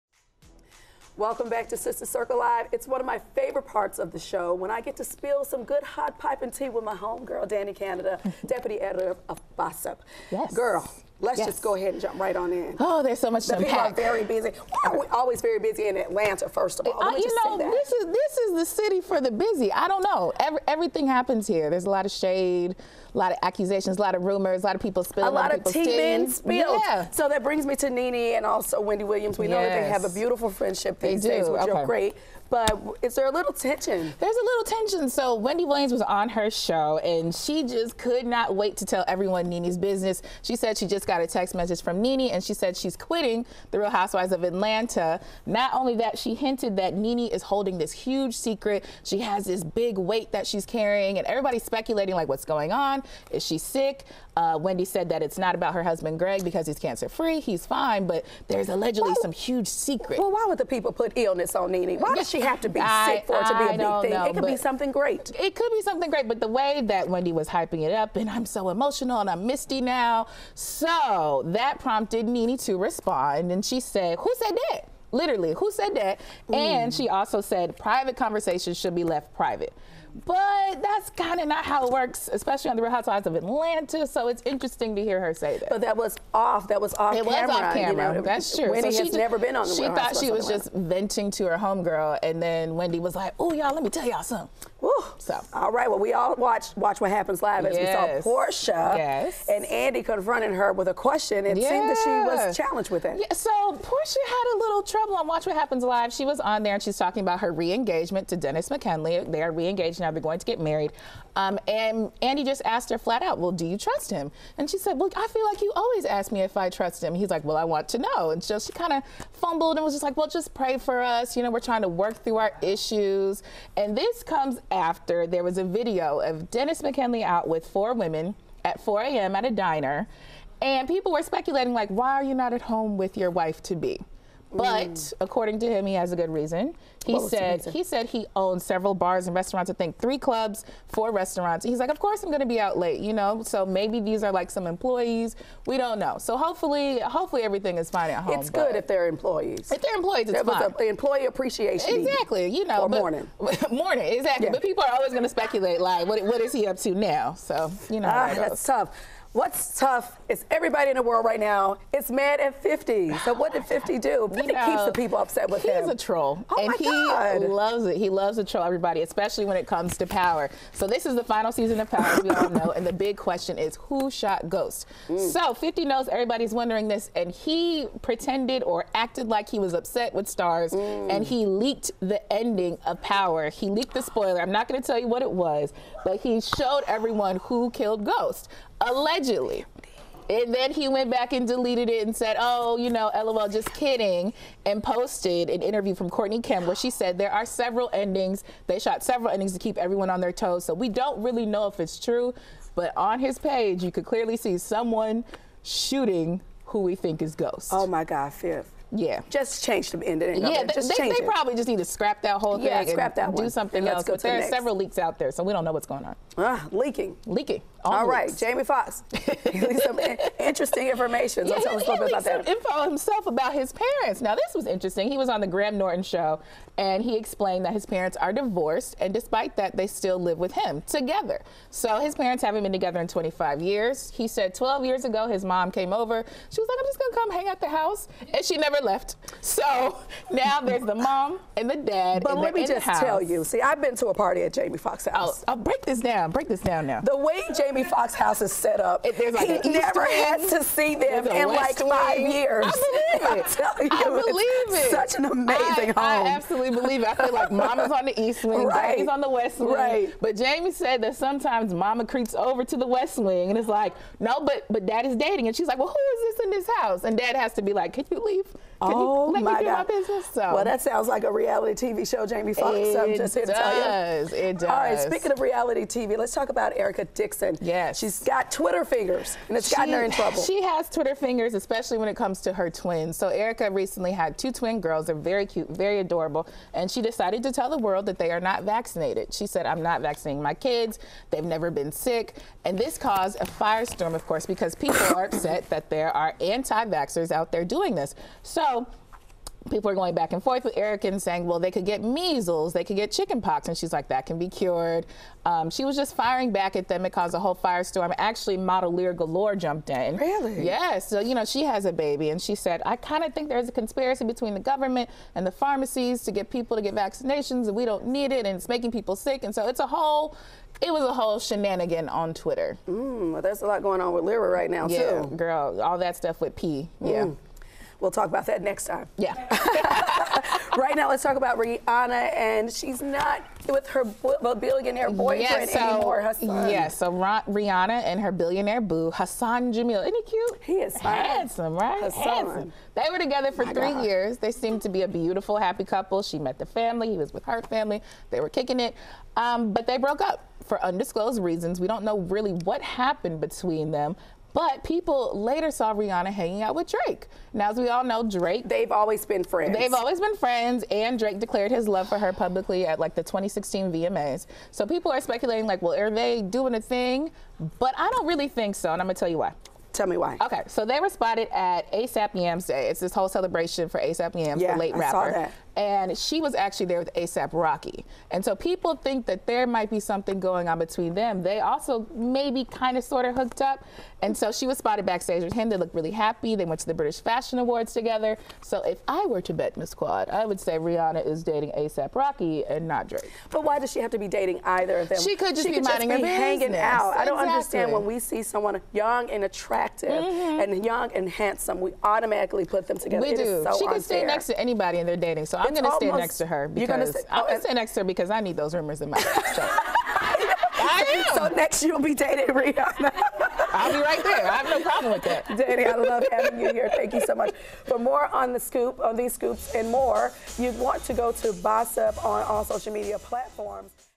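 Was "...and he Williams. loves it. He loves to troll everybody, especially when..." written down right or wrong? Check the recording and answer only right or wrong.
wrong.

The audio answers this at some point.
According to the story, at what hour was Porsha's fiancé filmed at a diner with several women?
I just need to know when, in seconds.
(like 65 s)
128 s.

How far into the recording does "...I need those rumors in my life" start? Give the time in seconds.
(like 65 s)
408 s.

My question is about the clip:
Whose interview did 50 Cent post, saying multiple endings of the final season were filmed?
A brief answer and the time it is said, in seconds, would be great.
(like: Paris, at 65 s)
Courtney Kemp, at 196 s.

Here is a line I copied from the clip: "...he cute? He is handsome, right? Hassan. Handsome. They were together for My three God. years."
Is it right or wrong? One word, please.
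right.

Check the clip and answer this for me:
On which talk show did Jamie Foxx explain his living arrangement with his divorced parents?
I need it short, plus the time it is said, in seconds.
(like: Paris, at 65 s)
The Graham Norton Show, at 225 s.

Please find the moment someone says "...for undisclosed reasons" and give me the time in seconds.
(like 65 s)
350 s.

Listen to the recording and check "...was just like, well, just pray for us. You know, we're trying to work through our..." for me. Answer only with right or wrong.
right.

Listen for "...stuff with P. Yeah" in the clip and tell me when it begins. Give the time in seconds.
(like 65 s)
326 s.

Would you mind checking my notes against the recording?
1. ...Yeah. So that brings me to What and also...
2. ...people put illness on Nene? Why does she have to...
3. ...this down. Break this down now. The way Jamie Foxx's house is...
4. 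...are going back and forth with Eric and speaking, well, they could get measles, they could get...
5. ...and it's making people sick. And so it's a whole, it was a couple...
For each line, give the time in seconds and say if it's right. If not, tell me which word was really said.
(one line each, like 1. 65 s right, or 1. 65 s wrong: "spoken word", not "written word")
1. 26 s wrong: "Nene", not "What"
2. 60 s right
3. 245 s right
4. 299 s wrong: "saying", not "speaking"
5. 318 s wrong: "whole", not "couple".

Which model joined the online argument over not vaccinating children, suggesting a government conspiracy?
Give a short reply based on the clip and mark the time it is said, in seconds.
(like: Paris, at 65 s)
Lira Galore, at 308 s.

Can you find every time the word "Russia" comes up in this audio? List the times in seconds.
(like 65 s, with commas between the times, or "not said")
not said.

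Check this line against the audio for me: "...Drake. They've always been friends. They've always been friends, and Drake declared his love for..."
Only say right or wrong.
right.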